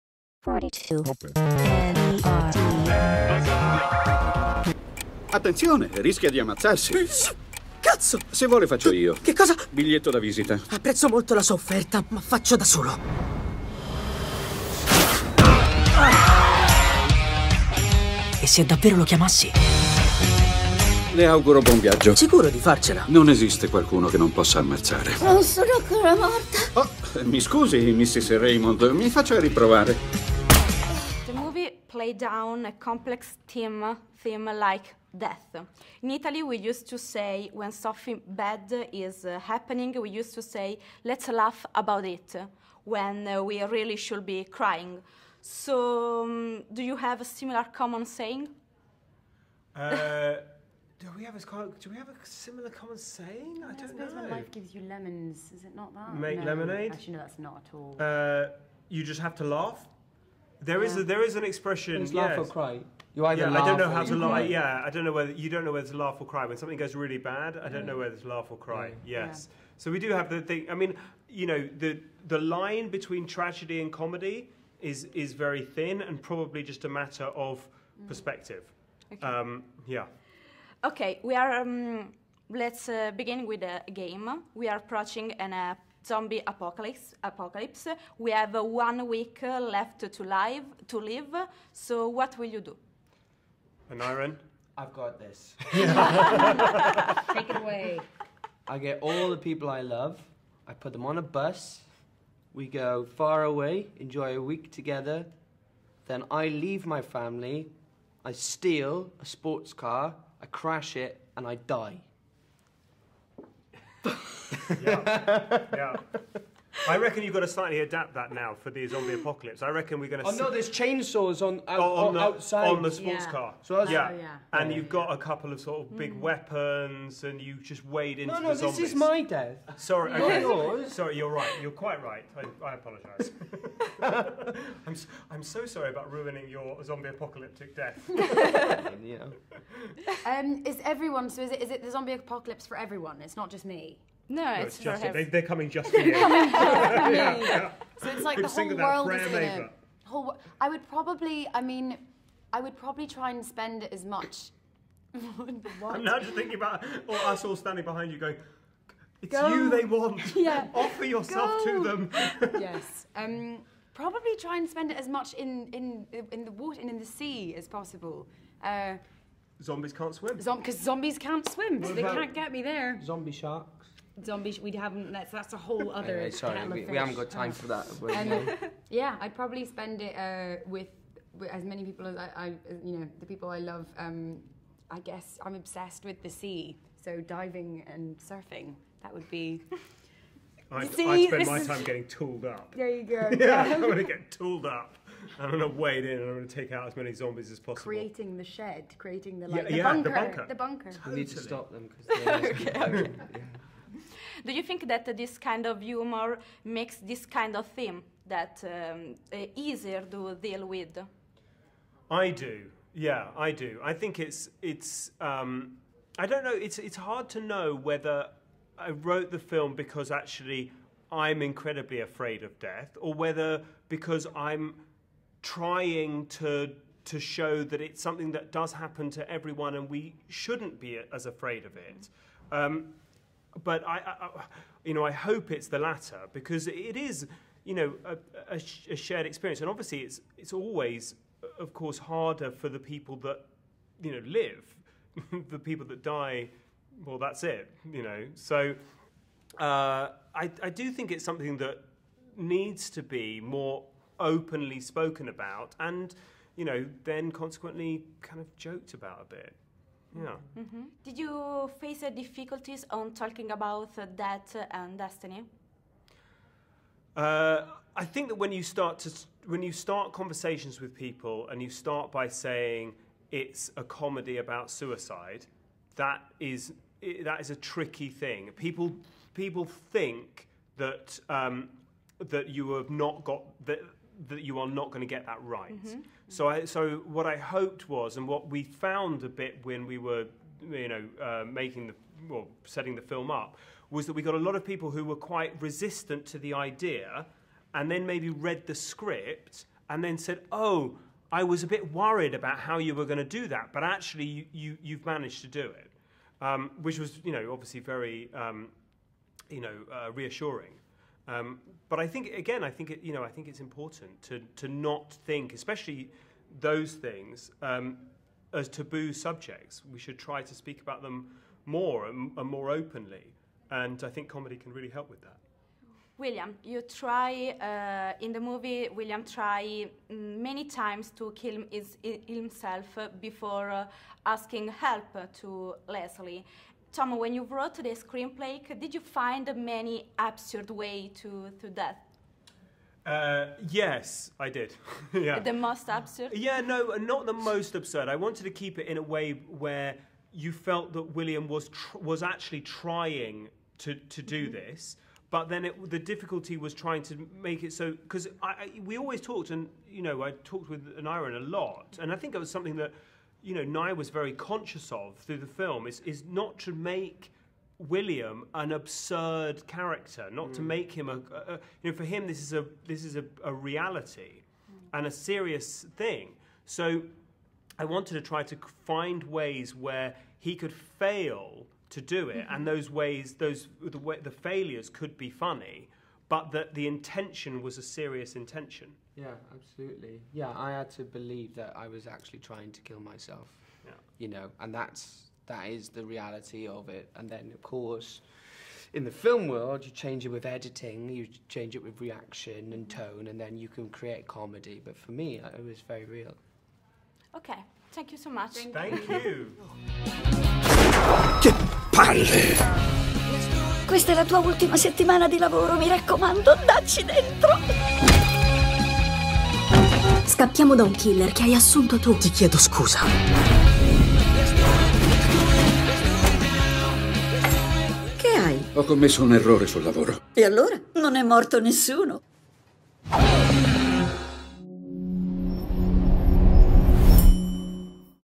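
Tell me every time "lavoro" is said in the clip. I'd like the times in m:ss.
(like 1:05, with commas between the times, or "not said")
6:55, 7:09.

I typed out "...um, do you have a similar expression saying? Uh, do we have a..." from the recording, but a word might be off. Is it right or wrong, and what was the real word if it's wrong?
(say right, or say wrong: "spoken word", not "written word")
wrong: "common", not "expression".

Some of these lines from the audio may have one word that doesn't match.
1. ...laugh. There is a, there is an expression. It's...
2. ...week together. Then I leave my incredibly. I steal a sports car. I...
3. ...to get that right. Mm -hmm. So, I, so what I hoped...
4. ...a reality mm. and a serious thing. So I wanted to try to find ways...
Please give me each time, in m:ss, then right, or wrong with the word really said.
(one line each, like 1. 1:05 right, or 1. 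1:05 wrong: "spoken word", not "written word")
1. 0:59 right
2. 1:44 wrong: "family", not "incredibly"
3. 4:45 right
4. 6:13 right.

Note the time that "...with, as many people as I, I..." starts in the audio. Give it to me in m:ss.
3:01.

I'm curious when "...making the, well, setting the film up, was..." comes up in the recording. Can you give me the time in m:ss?
4:51.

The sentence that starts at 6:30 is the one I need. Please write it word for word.
Yeah, I had to believe that I was actually trying to kill myself.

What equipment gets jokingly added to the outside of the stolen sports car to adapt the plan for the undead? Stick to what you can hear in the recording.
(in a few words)
Chainsaws.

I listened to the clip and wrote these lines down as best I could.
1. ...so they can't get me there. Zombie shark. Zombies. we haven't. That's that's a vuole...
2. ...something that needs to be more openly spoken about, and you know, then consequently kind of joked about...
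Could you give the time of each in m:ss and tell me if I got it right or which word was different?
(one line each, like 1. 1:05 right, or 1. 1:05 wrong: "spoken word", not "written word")
1. 2:51 wrong: "whole", not "vuole"
2. 4:11 right.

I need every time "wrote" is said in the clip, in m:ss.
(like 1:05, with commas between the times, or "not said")
3:38, 5:37.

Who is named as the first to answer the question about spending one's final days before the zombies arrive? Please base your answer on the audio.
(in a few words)
Aneurin.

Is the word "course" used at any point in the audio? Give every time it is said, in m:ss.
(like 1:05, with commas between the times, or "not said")
4:01, 6:37.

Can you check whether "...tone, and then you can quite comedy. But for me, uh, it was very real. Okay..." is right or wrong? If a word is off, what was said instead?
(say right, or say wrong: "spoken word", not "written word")
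wrong: "create", not "quite".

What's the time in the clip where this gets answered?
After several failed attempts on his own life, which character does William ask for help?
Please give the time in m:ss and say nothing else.
5:35.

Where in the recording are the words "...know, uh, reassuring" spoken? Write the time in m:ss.
5:09.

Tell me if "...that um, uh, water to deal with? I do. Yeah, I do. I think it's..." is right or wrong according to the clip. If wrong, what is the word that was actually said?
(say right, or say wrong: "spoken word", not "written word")
wrong: "easier", not "water".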